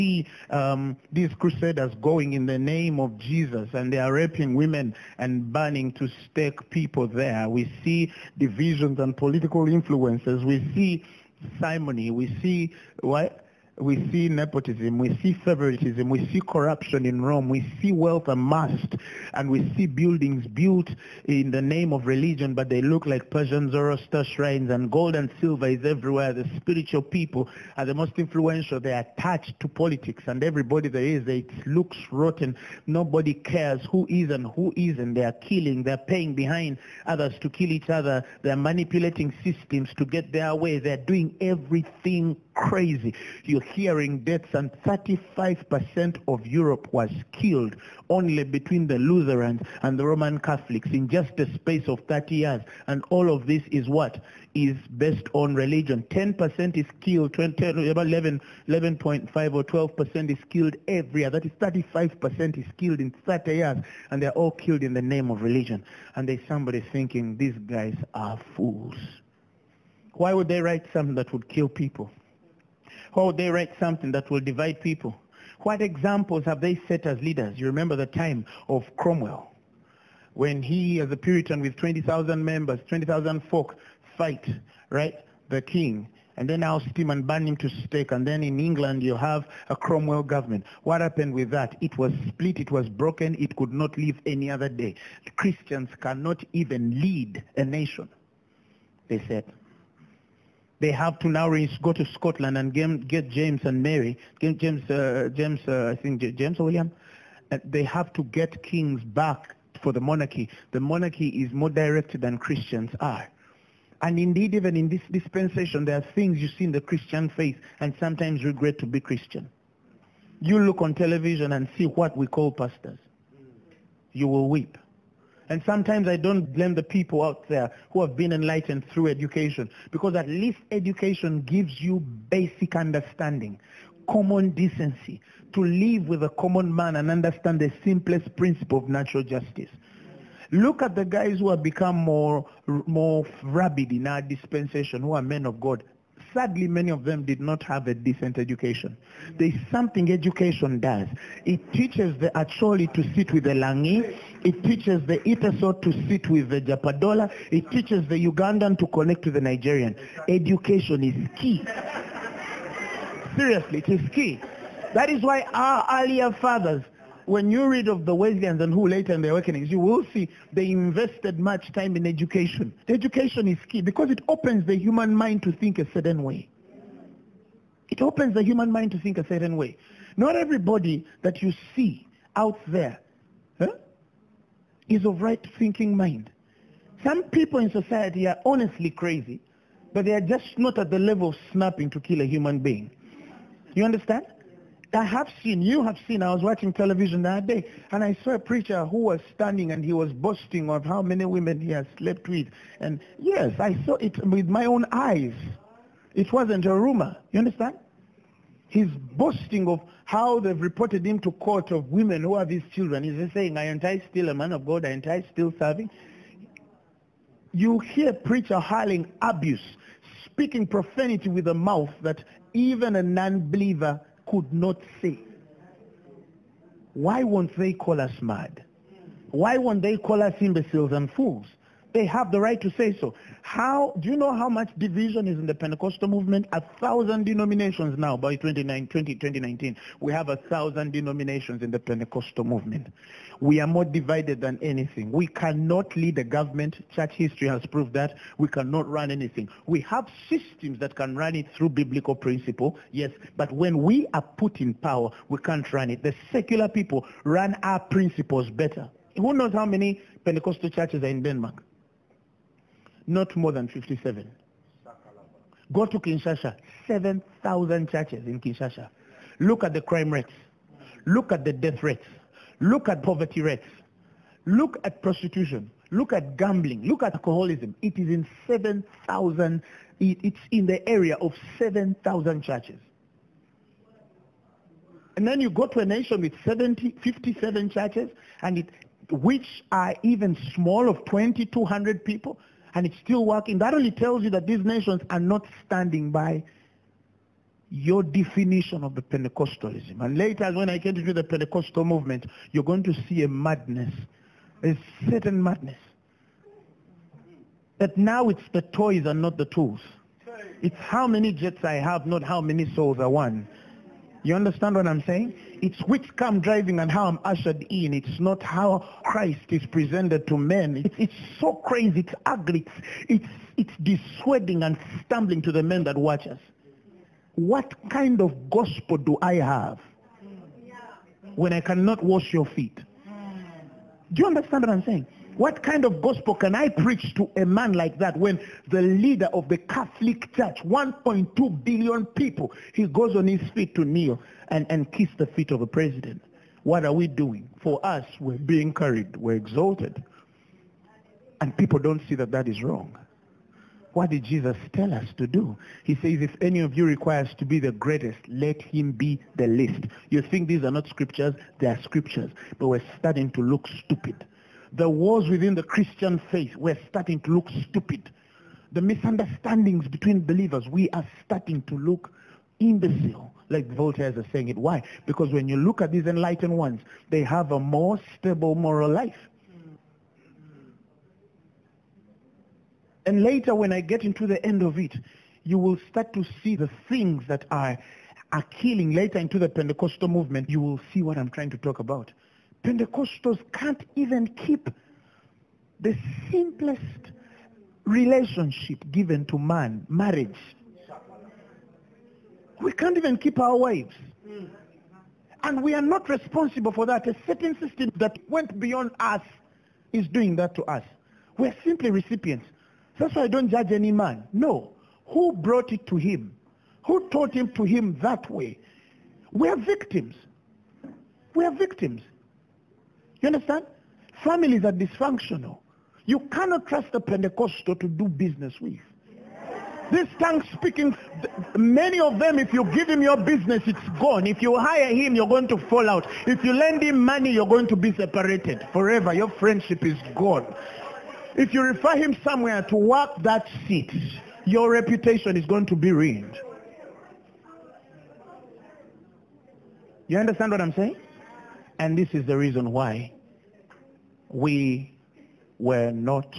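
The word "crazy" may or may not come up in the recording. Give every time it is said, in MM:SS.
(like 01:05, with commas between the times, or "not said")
00:42, 03:08, 05:21.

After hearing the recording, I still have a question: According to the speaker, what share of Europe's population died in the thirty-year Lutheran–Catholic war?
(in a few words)
35%.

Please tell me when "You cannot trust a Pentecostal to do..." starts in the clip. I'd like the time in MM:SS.
07:06.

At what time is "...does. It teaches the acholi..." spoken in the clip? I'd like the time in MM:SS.
02:30.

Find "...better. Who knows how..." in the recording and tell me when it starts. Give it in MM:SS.
04:18.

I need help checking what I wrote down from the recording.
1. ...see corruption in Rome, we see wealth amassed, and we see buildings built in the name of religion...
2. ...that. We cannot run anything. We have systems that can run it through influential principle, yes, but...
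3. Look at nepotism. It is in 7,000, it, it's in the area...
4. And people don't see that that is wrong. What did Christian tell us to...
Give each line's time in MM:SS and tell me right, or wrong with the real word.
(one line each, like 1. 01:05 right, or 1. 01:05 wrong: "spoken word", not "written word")
1. 00:16 right
2. 04:07 wrong: "biblical", not "influential"
3. 04:36 wrong: "alcoholism", not "nepotism"
4. 05:51 wrong: "Jesus", not "Christian".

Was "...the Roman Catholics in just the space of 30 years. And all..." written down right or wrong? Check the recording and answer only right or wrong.
right.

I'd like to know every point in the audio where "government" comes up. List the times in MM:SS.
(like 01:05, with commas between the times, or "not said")
01:30, 04:06.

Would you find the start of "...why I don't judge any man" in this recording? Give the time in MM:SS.
06:53.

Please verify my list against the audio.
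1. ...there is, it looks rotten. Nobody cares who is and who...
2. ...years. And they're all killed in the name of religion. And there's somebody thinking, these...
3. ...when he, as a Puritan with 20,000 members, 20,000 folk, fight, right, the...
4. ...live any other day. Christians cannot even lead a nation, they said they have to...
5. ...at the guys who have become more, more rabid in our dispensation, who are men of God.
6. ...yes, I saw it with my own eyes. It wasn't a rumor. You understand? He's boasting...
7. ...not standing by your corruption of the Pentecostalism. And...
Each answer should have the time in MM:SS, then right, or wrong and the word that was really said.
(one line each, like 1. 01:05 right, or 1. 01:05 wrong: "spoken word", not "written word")
1. 00:30 right
2. 01:03 right
3. 01:20 right
4. 01:33 right
5. 02:20 right
6. 03:23 right
7. 04:55 wrong: "definition", not "corruption".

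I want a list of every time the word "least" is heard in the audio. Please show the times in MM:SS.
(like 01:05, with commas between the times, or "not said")
02:10, 05:59.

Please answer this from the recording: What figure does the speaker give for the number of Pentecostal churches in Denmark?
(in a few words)
57.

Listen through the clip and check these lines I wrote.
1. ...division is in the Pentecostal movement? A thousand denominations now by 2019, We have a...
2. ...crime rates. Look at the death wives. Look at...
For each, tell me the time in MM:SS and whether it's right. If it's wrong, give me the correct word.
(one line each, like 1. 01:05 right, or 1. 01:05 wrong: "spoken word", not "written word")
1. 03:54 right
2. 04:29 wrong: "rates", not "wives".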